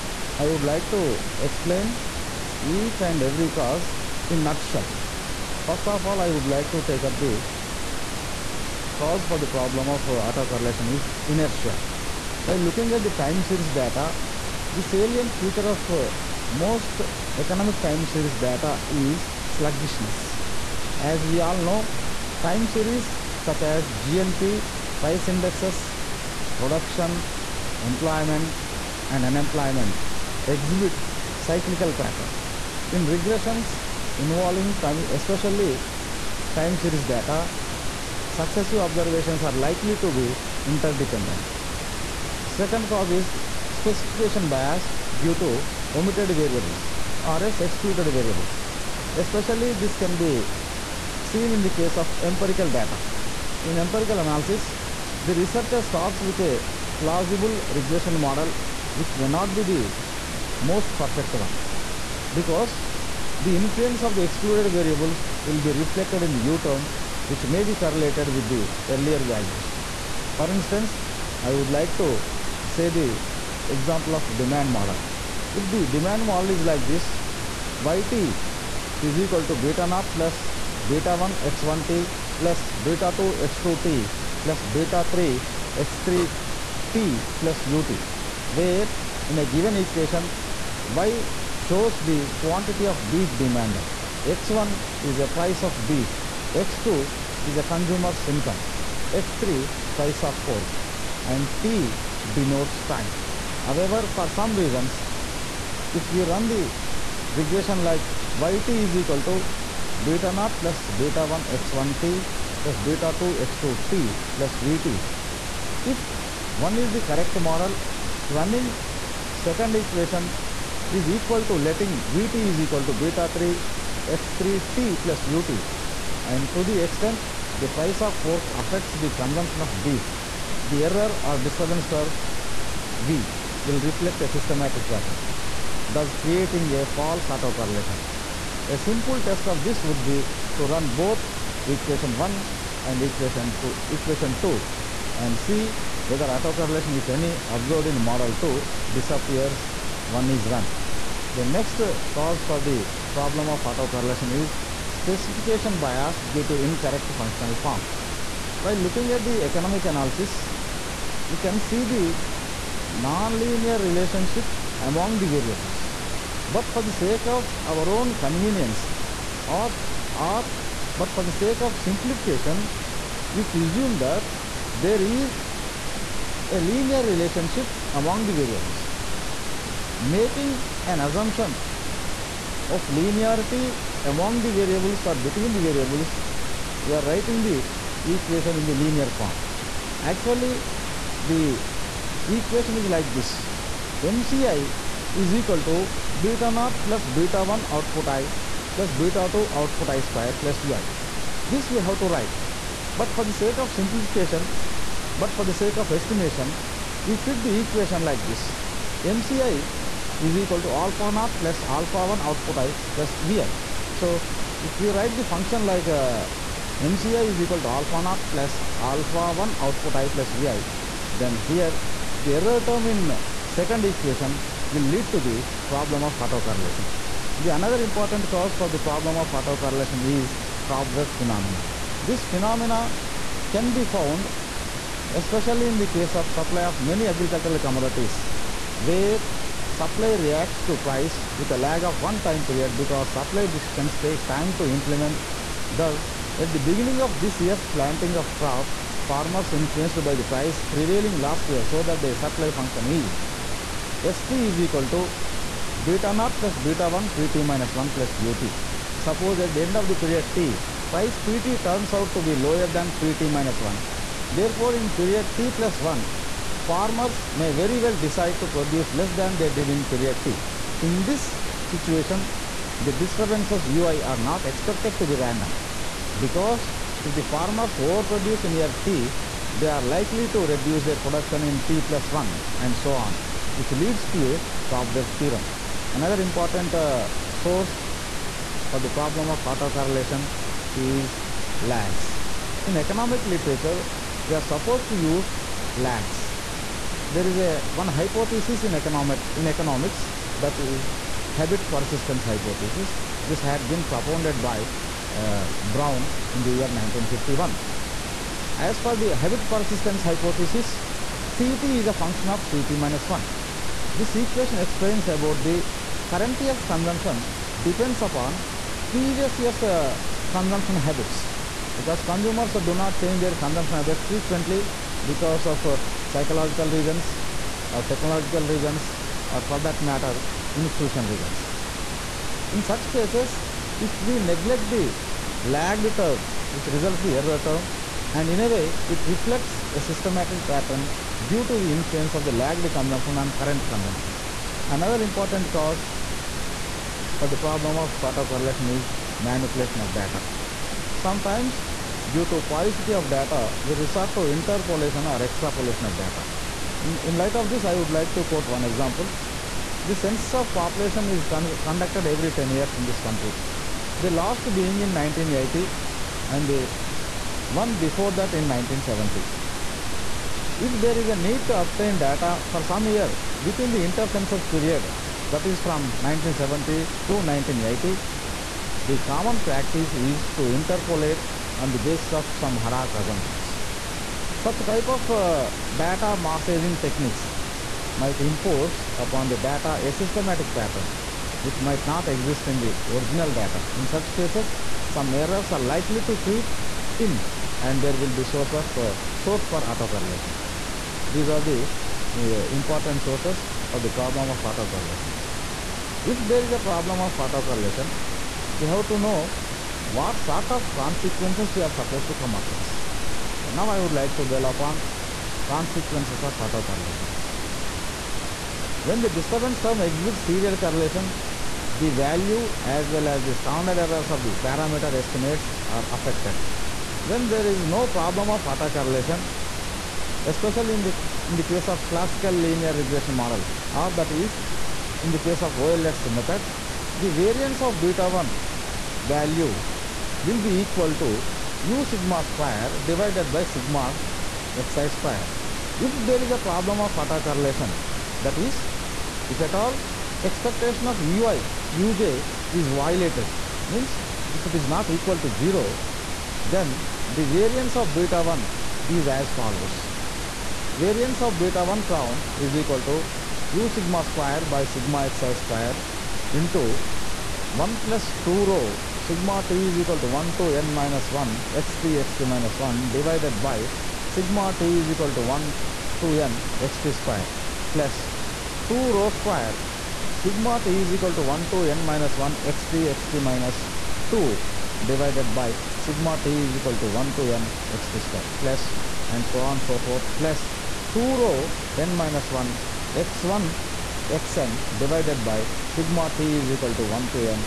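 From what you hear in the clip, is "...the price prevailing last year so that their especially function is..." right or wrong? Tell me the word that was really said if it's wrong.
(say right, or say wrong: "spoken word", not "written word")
wrong: "supply", not "especially".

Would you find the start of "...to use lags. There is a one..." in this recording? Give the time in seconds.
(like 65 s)
294 s.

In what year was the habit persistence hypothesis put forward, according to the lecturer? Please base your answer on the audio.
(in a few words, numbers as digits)
1951.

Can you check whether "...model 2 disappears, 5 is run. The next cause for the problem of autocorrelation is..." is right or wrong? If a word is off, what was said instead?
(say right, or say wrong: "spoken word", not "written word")
wrong: "1", not "5".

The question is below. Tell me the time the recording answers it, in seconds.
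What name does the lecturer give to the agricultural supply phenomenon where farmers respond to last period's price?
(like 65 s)
230 s.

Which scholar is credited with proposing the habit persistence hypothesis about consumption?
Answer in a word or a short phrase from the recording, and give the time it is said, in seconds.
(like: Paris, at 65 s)
Brown, at 305 s.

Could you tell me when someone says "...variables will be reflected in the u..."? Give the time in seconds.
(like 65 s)
64 s.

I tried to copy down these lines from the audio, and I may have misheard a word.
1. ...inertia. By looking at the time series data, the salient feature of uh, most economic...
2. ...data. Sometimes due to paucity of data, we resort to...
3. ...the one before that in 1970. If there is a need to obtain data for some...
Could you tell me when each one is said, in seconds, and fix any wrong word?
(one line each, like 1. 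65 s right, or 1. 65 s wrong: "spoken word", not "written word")
1. 11 s right
2. 349 s right
3. 366 s right.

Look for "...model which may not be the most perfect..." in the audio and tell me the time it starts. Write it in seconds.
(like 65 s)
58 s.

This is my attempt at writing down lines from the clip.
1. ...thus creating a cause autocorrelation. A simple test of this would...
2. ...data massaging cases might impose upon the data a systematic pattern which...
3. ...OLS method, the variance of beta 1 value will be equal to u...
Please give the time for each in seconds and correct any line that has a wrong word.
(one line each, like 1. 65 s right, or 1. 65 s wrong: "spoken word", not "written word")
1. 135 s wrong: "false", not "cause"
2. 385 s wrong: "techniques", not "cases"
3. 435 s right.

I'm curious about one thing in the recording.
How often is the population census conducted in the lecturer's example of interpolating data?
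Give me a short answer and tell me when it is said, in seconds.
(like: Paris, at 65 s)
every 10 years, at 362 s.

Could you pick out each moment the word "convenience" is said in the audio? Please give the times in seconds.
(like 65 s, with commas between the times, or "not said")
168 s.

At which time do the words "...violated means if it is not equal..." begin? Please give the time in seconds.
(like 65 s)
452 s.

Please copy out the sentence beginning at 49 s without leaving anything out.
Especially this can be seen in the case of empirical data.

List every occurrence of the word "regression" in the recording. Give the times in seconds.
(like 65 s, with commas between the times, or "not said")
33 s, 57 s, 107 s, 432 s.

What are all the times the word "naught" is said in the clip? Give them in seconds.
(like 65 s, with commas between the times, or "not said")
79 s, 110 s, 196 s, 211 s, 218 s, 256 s.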